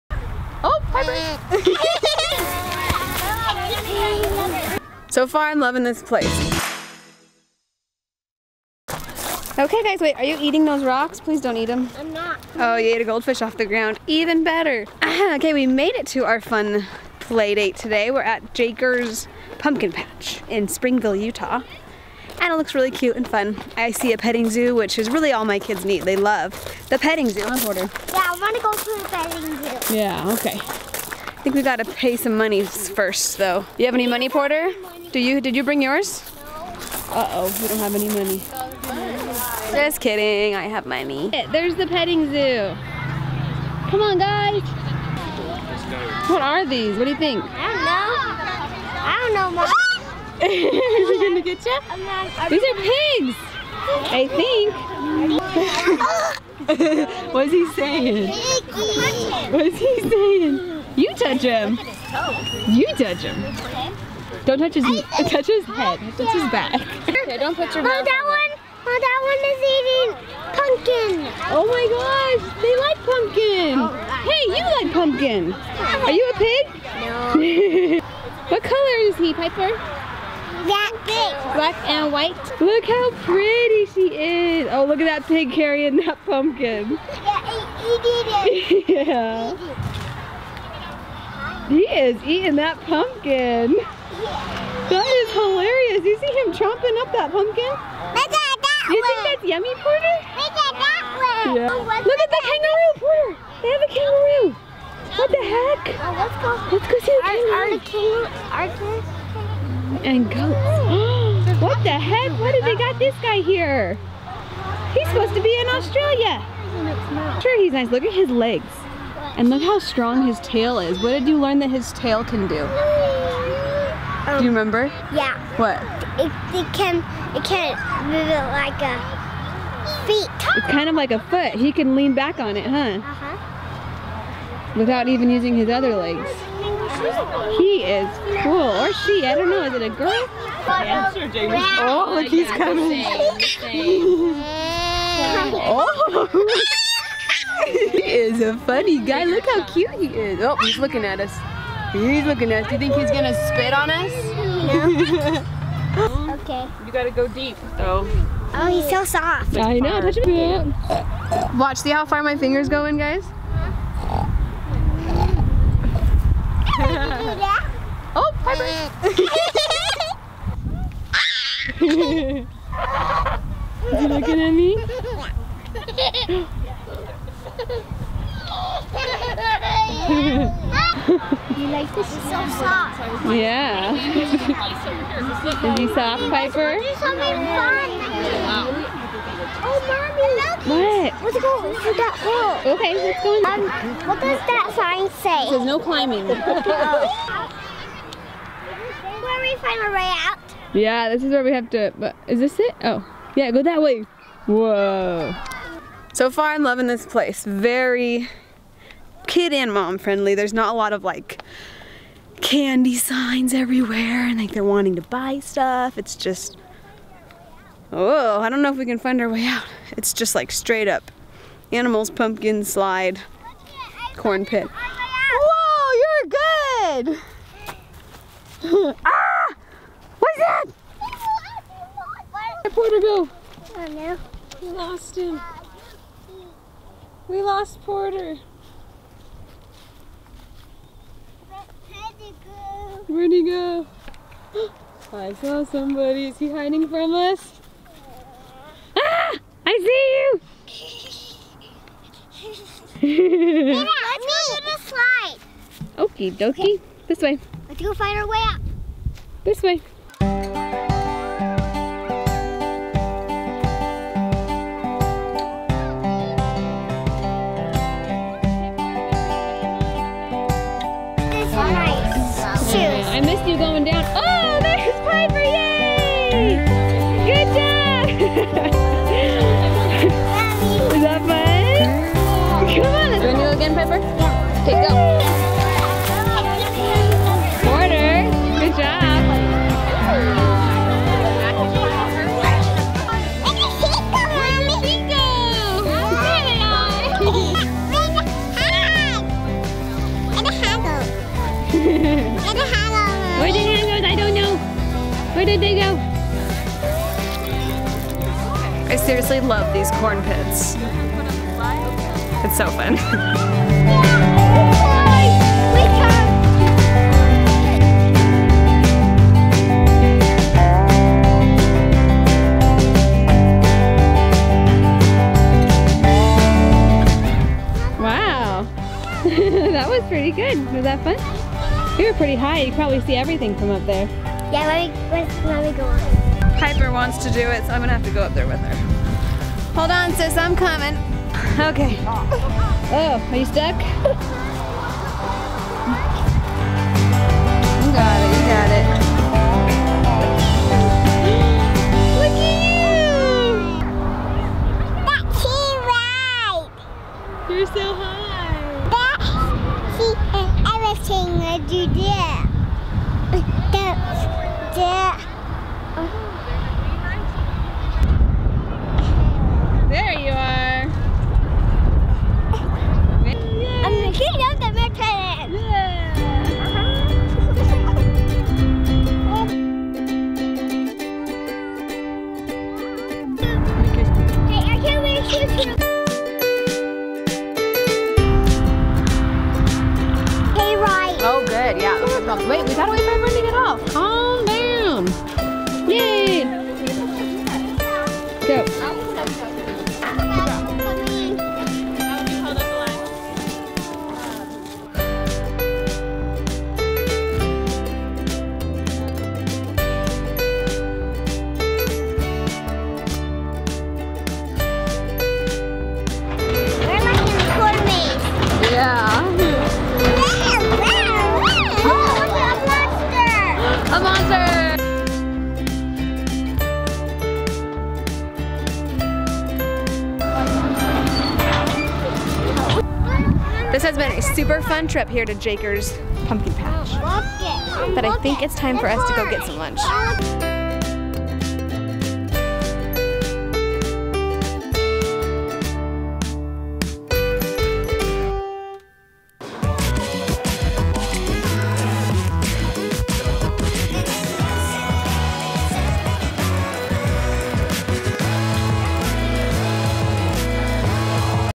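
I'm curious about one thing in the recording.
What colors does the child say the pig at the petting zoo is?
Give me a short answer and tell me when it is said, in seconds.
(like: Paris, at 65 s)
Black and white, at 81 s.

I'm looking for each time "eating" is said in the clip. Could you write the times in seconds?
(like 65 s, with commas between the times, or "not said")
10 s, 70 s, 92 s.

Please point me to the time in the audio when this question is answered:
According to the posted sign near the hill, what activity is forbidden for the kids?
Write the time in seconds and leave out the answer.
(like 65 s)
195 s.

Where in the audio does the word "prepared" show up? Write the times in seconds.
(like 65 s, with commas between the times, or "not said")
not said.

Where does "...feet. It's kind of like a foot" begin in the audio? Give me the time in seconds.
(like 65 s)
130 s.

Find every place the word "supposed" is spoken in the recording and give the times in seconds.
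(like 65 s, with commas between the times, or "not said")
115 s.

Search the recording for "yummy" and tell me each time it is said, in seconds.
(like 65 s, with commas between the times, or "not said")
99 s.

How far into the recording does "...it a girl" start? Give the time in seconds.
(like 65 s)
139 s.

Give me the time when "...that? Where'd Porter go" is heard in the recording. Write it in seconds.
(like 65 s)
230 s.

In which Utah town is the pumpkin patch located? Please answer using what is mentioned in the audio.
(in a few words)
Springville.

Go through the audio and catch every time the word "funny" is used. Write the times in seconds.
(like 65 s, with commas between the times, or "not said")
148 s.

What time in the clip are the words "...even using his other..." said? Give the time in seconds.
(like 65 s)
135 s.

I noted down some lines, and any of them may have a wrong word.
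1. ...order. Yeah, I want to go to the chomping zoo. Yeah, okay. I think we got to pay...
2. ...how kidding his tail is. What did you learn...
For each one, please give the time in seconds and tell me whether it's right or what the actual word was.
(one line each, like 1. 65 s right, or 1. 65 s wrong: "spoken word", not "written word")
1. 27 s wrong: "petting", not "chomping"
2. 119 s wrong: "strong", not "kidding".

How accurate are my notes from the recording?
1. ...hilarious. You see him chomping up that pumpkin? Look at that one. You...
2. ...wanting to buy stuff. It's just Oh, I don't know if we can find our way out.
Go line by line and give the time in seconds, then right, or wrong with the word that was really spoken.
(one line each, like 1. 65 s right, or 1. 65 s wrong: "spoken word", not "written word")
1. 95 s right
2. 214 s right.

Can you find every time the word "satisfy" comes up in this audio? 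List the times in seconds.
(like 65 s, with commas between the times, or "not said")
not said.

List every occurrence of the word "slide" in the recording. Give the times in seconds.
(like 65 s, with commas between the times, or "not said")
222 s, 254 s.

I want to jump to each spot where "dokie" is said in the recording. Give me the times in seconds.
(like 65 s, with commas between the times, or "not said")
256 s.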